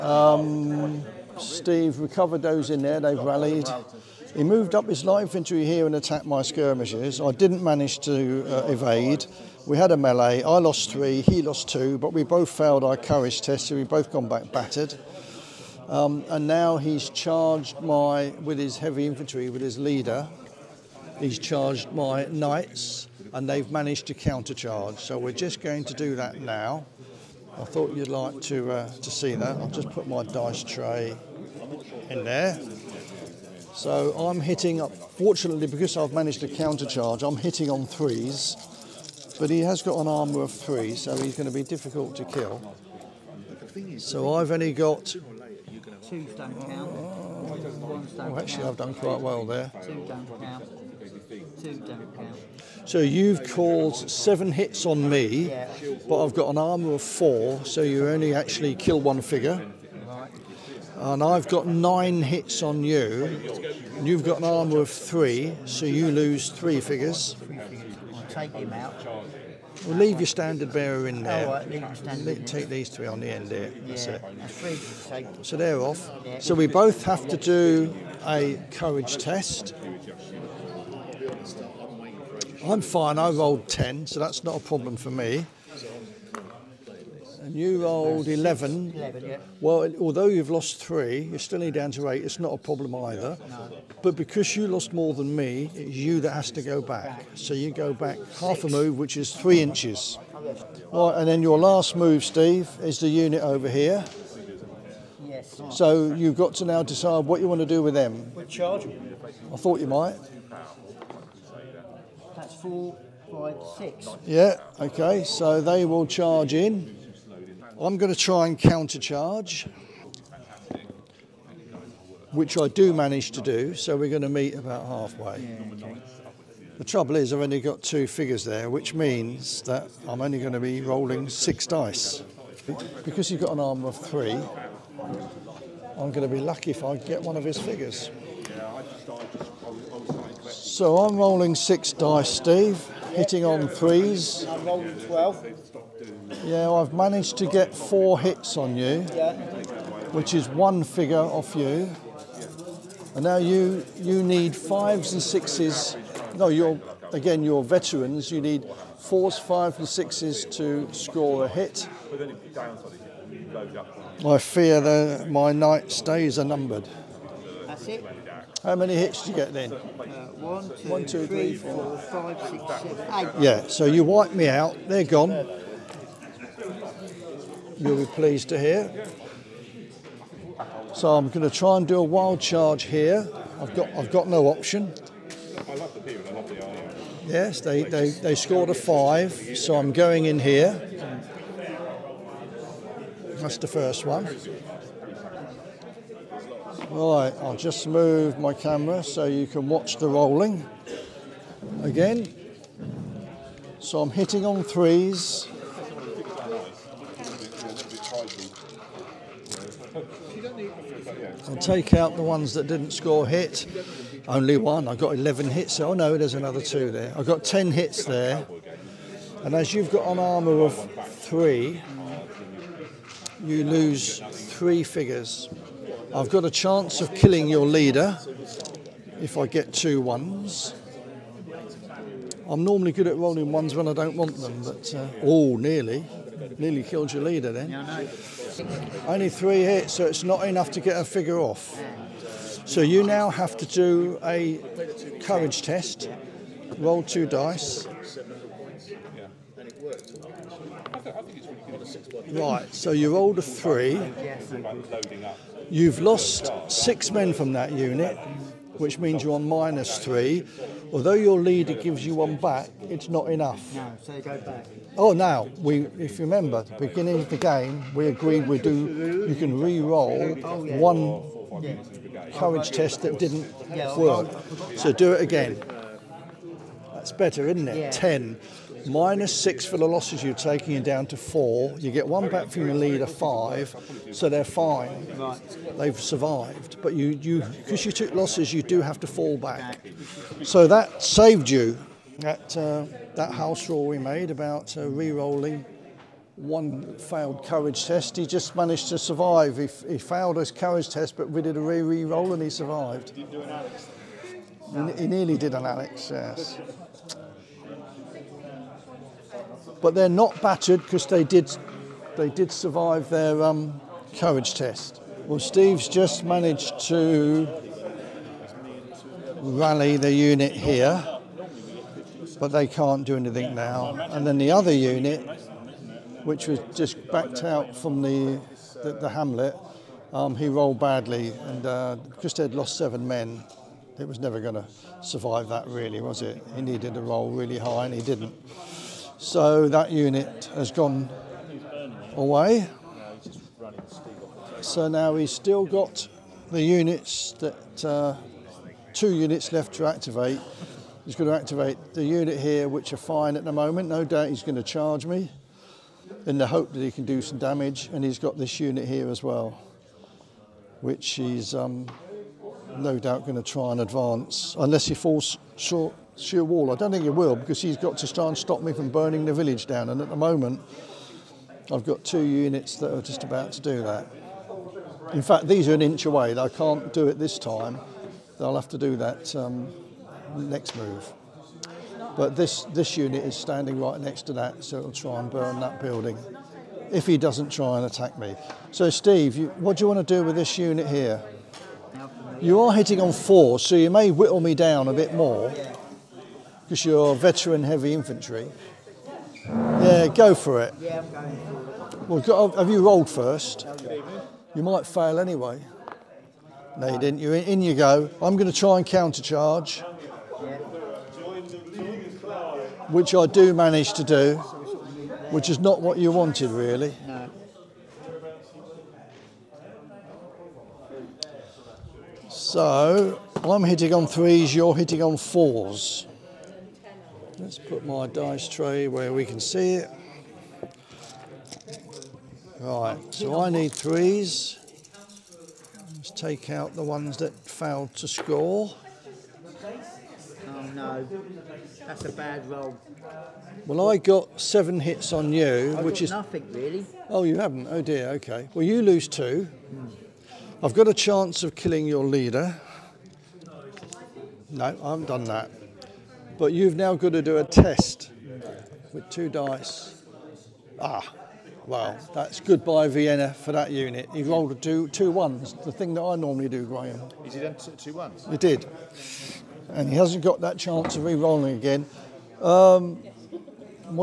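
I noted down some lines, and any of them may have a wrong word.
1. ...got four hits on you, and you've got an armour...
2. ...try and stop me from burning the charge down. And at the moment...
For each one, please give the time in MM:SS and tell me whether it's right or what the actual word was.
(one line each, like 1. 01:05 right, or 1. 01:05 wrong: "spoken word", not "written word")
1. 01:01 wrong: "nine", not "four"
2. 06:08 wrong: "village", not "charge".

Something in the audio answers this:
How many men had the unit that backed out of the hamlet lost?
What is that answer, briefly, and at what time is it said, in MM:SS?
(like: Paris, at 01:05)
7, at 05:32.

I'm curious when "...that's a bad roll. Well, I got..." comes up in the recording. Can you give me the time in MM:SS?
07:21.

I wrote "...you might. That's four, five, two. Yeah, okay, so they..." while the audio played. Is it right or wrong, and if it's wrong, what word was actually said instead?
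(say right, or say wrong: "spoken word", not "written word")
wrong: "six", not "two".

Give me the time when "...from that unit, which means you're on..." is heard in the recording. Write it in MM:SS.
04:17.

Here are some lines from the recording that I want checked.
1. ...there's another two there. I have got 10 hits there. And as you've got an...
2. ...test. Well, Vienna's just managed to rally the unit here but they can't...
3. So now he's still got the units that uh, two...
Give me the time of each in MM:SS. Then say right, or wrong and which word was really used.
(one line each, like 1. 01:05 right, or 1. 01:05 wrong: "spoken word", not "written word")
1. 03:36 right
2. 05:14 wrong: "Steve", not "Vienna"
3. 05:44 right.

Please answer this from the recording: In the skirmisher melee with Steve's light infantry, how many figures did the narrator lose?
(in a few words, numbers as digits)
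3.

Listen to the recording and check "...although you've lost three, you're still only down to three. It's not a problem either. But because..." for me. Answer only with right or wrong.
wrong.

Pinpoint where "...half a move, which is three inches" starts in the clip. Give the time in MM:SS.
01:38.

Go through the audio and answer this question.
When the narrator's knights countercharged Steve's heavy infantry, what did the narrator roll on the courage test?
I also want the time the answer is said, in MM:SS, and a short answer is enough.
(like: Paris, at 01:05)
10, at 01:23.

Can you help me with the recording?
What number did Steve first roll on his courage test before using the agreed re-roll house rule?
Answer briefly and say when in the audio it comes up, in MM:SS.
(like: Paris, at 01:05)
3, at 04:12.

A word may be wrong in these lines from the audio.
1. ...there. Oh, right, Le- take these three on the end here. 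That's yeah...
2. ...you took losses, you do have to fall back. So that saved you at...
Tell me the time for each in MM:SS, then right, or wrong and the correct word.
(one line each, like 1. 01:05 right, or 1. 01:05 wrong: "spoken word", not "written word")
1. 01:11 right
2. 04:47 right.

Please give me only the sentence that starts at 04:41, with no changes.
You get one back from your leader, five, so they're fine.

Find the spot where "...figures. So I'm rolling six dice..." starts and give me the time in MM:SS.
02:17.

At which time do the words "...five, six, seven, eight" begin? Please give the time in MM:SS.
02:52.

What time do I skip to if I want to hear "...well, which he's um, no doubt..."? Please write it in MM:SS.
05:59.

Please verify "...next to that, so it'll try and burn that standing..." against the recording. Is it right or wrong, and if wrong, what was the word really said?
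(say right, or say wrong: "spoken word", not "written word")
wrong: "building", not "standing".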